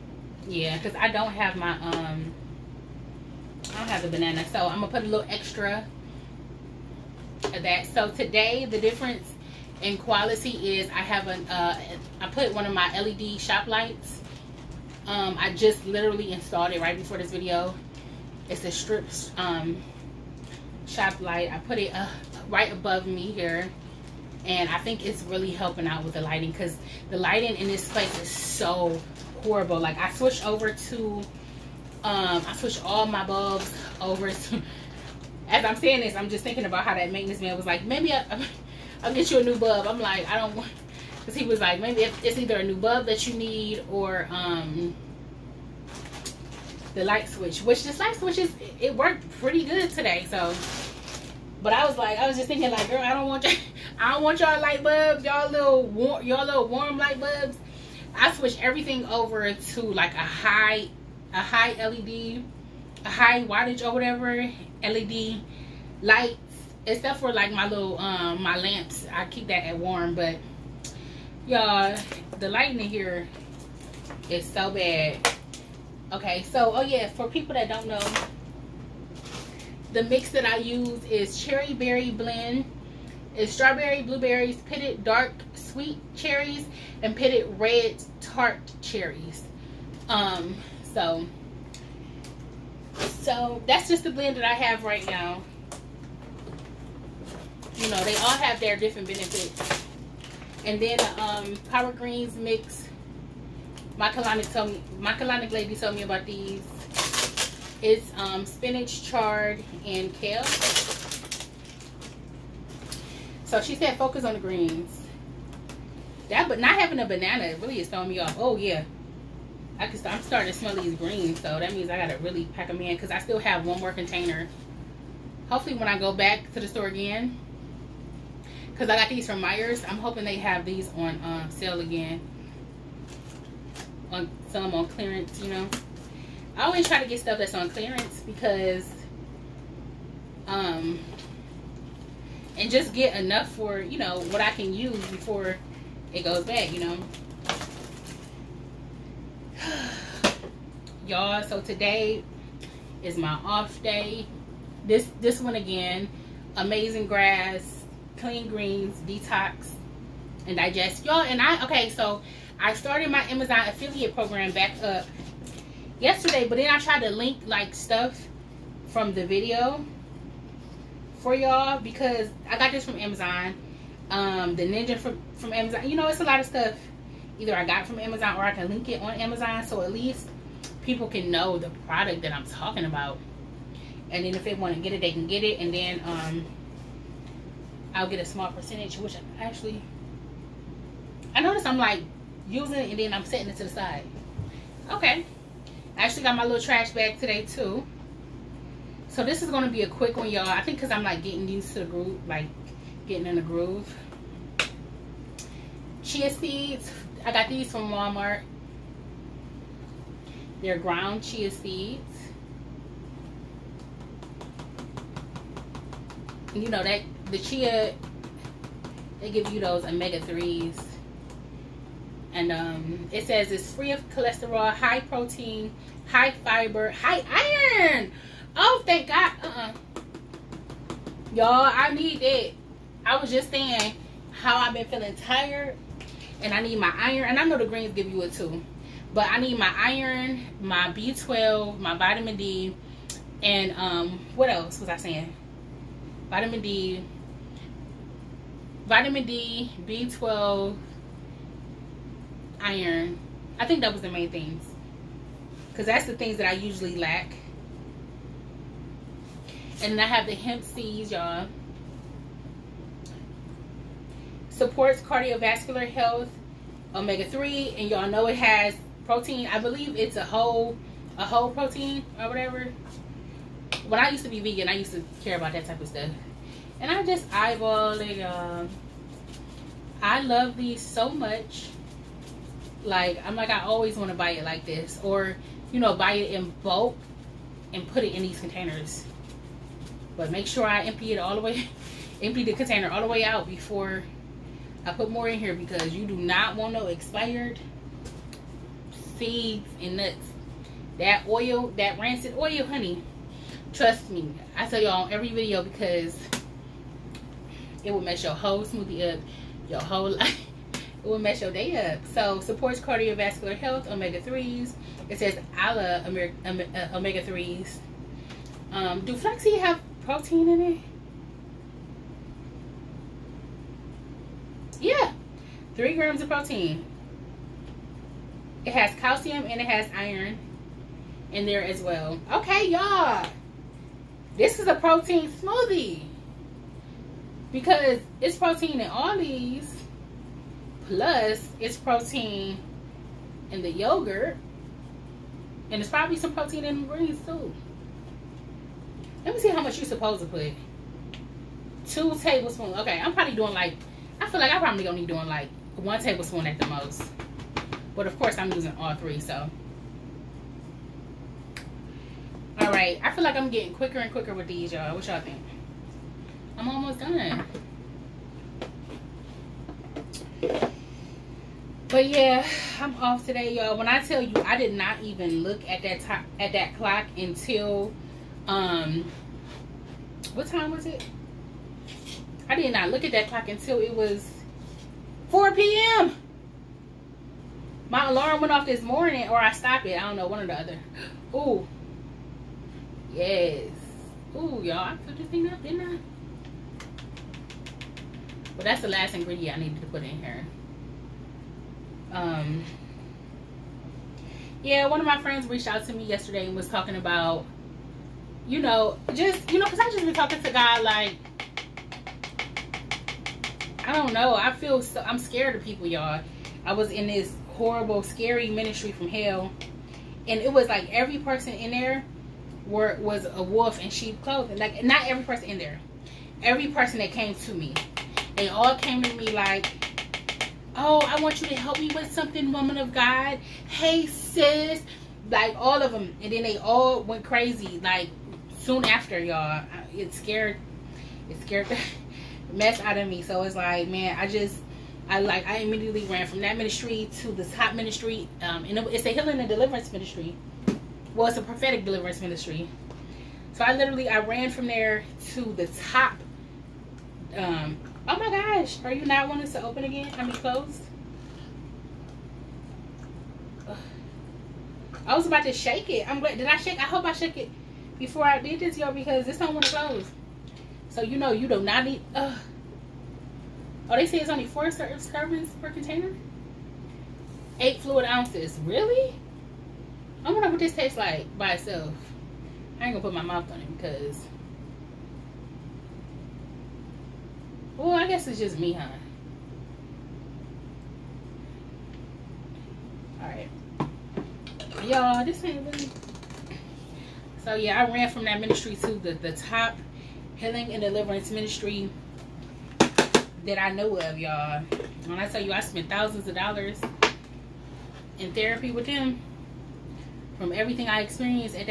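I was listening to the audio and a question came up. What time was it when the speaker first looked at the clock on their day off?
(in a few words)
4 p.m.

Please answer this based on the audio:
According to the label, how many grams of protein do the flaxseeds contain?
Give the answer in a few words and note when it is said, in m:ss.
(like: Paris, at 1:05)
3 grams, at 5:25.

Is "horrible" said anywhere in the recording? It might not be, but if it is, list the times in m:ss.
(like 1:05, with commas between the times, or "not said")
0:29, 6:57.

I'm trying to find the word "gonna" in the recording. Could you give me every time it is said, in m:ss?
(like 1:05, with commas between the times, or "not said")
0:04, 5:54, 8:02.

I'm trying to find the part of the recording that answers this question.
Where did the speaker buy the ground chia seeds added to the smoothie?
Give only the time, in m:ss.
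3:27.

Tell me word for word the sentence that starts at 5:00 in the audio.
That oil, that rancid oil, honey.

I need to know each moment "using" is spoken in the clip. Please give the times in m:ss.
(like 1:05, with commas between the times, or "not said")
3:12, 5:58.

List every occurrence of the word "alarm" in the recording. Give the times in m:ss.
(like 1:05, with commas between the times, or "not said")
6:28.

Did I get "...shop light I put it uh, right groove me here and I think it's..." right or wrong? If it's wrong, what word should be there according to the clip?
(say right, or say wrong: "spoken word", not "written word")
wrong: "above", not "groove".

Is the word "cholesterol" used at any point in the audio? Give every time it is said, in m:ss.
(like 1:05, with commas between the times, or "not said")
3:44.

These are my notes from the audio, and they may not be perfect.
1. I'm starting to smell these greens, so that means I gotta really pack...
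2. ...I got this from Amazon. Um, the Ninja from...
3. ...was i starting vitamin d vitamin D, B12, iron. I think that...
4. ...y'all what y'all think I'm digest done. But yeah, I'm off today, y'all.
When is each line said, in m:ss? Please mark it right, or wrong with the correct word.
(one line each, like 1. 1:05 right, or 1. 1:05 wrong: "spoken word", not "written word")
1. 2:00 right
2. 2:52 right
3. 4:04 wrong: "saying", not "starting"
4. 6:04 wrong: "almost", not "digest".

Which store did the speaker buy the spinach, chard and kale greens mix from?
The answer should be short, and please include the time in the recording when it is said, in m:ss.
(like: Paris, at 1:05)
Meijer's, at 2:09.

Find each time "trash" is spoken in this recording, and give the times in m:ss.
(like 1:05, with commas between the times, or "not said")
3:16.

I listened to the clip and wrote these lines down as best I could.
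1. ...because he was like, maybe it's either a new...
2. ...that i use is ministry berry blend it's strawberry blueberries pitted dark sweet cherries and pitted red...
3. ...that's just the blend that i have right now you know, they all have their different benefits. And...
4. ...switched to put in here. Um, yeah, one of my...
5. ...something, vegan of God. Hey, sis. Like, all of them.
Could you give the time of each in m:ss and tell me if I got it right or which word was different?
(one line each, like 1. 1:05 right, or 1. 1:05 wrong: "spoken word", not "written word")
1. 0:41 right
2. 1:20 wrong: "cherry", not "ministry"
3. 1:33 right
4. 6:39 wrong: "needed", not "switched"
5. 7:12 wrong: "woman", not "vegan".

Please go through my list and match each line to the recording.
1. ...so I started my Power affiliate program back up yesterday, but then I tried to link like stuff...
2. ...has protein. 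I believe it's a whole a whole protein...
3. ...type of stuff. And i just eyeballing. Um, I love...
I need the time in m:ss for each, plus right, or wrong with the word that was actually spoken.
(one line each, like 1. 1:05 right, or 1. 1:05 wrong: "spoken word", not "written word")
1. 2:41 wrong: "Amazon", not "Power"
2. 4:28 right
3. 4:35 right.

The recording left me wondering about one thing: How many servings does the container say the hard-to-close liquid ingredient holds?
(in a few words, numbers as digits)
4.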